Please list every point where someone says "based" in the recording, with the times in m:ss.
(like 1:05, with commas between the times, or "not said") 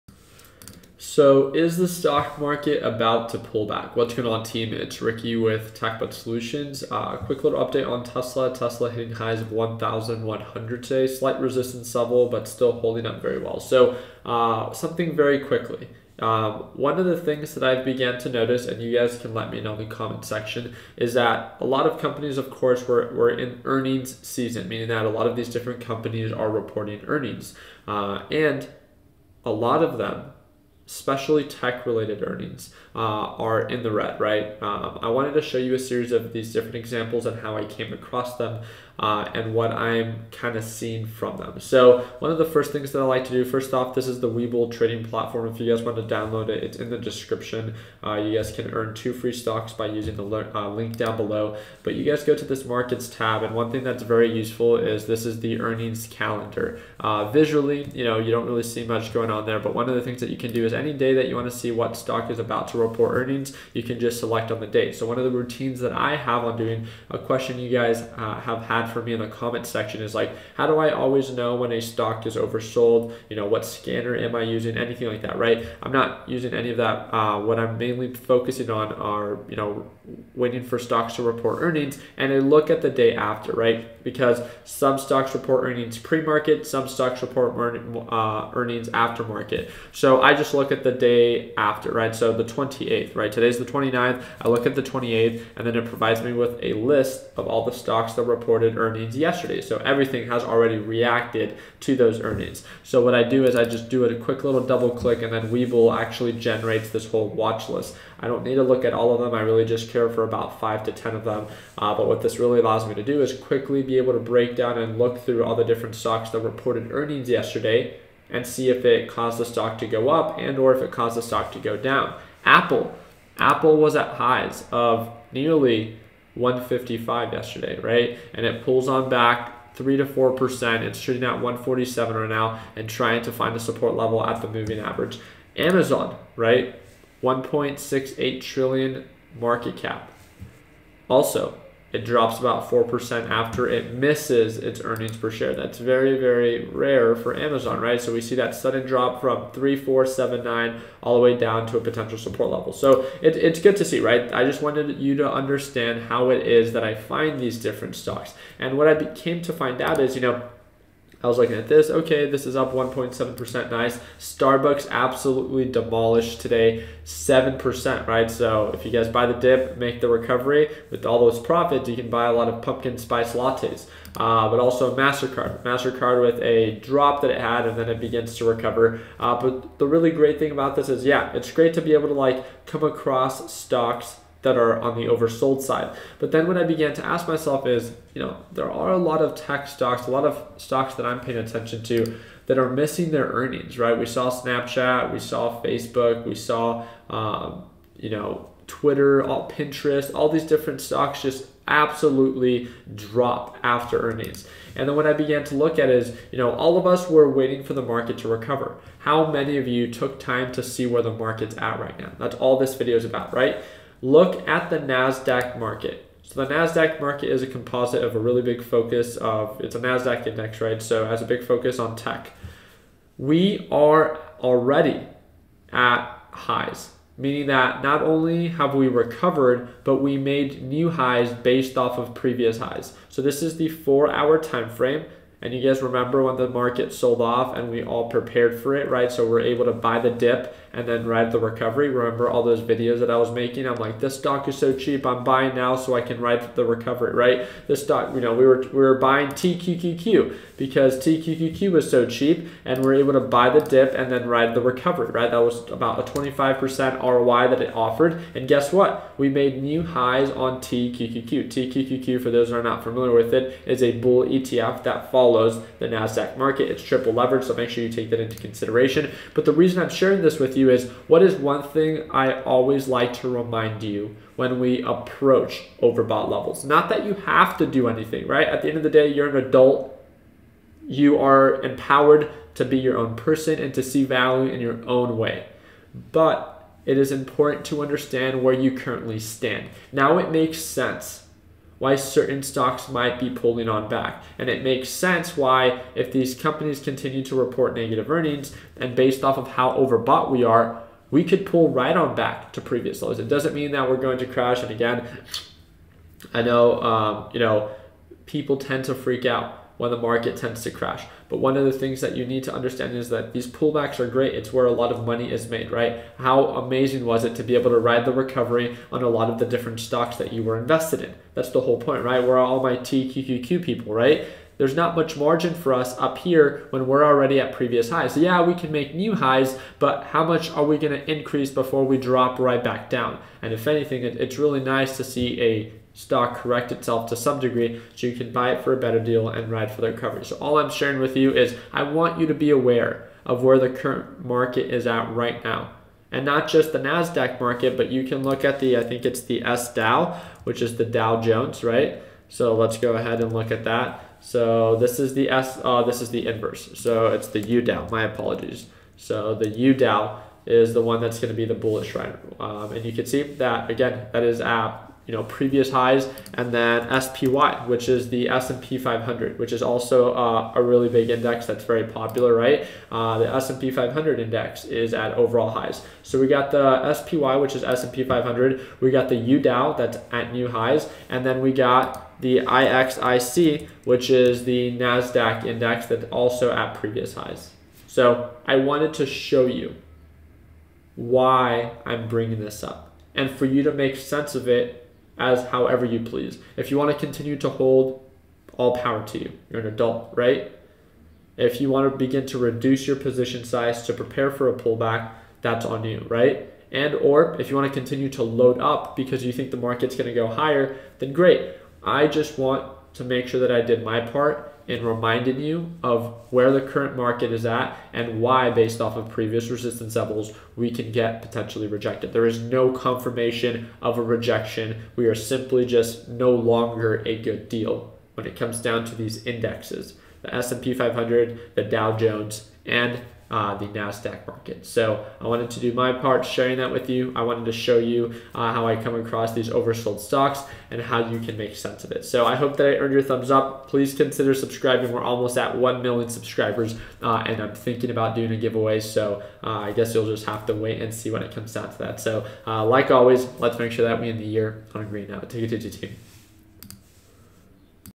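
3:51, 4:58, 6:58.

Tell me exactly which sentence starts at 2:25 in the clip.
That's very, very rare for Amazon, right?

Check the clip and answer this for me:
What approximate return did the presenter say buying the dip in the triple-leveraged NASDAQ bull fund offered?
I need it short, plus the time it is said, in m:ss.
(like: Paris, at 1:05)
25%, at 4:16.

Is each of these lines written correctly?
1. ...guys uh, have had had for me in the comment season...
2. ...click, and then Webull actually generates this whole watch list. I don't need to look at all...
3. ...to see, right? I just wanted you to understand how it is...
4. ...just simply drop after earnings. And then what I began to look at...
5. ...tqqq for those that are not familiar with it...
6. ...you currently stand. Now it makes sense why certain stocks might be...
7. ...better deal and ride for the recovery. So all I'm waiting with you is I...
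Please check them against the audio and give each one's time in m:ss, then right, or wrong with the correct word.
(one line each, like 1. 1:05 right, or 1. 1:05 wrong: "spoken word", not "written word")
1. 1:07 wrong: "section", not "season"
2. 1:44 right
3. 2:33 right
4. 3:21 wrong: "absolutely", not "simply"
5. 4:21 right
6. 4:48 right
7. 5:38 wrong: "sharing", not "waiting".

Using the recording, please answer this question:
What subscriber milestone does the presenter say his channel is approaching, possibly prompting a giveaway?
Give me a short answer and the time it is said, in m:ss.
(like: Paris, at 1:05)
1 million, at 7:25.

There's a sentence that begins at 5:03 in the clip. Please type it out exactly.
It doesn't mean that we're going to crash.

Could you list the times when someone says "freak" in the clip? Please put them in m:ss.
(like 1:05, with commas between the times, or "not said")
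5:08.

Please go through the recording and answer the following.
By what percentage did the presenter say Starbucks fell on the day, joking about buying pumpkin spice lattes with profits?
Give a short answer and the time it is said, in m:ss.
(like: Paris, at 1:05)
7%, at 2:47.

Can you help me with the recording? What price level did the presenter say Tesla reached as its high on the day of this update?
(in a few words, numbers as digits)
1,100.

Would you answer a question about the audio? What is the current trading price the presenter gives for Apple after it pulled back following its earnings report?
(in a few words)
147.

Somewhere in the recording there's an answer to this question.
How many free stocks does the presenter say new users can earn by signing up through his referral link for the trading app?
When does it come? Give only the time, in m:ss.
0:48.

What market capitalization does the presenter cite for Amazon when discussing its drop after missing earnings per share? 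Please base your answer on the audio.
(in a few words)
1.68 trillion.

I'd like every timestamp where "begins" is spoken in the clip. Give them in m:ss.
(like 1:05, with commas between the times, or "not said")
2:57, 6:41.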